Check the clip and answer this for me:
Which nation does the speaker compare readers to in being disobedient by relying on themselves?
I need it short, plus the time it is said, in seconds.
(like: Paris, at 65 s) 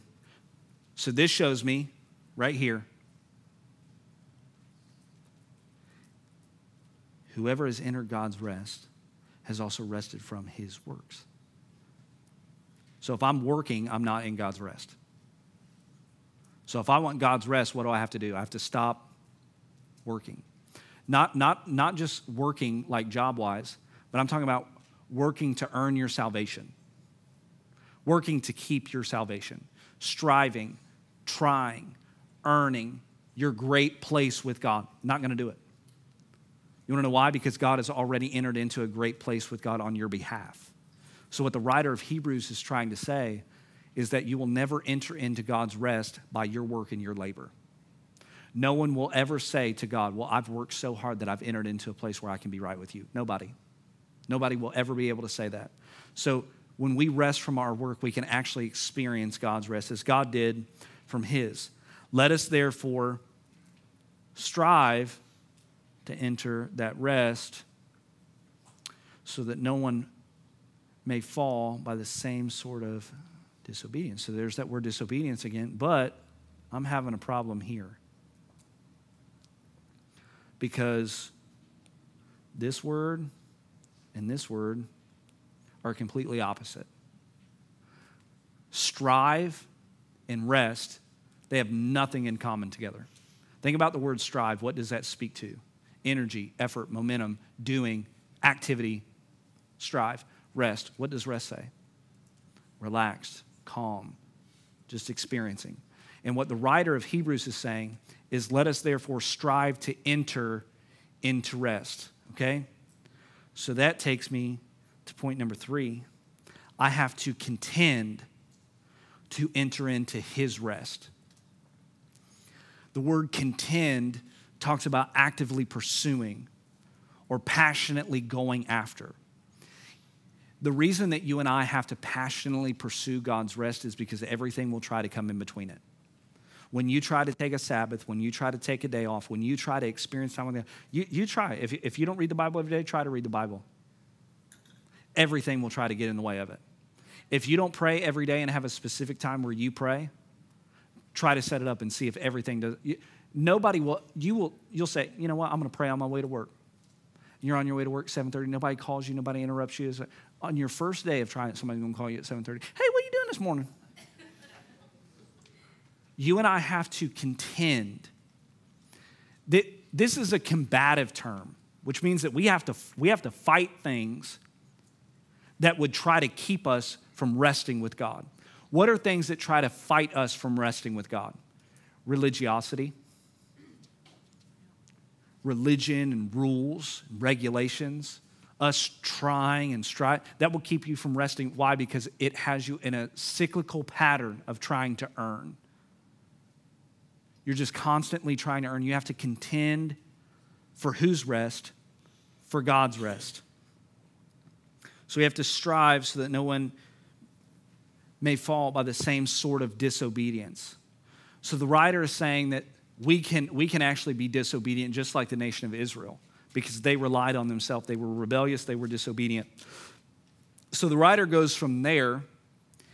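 Israel, at 215 s.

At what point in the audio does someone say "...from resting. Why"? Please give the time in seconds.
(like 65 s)
190 s.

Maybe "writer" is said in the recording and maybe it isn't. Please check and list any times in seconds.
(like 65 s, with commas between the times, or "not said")
41 s, 106 s, 211 s, 220 s.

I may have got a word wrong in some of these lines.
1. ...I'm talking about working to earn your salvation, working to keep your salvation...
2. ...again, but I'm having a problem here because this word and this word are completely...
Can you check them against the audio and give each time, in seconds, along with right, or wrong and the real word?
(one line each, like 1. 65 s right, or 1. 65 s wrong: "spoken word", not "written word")
1. 24 s right
2. 75 s right.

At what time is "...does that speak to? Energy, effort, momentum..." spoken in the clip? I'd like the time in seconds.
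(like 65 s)
94 s.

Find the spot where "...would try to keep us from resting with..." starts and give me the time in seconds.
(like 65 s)
175 s.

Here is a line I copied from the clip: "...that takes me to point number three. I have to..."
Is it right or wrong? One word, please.
right.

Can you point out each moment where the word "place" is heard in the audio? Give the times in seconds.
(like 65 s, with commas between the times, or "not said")
33 s, 39 s, 51 s.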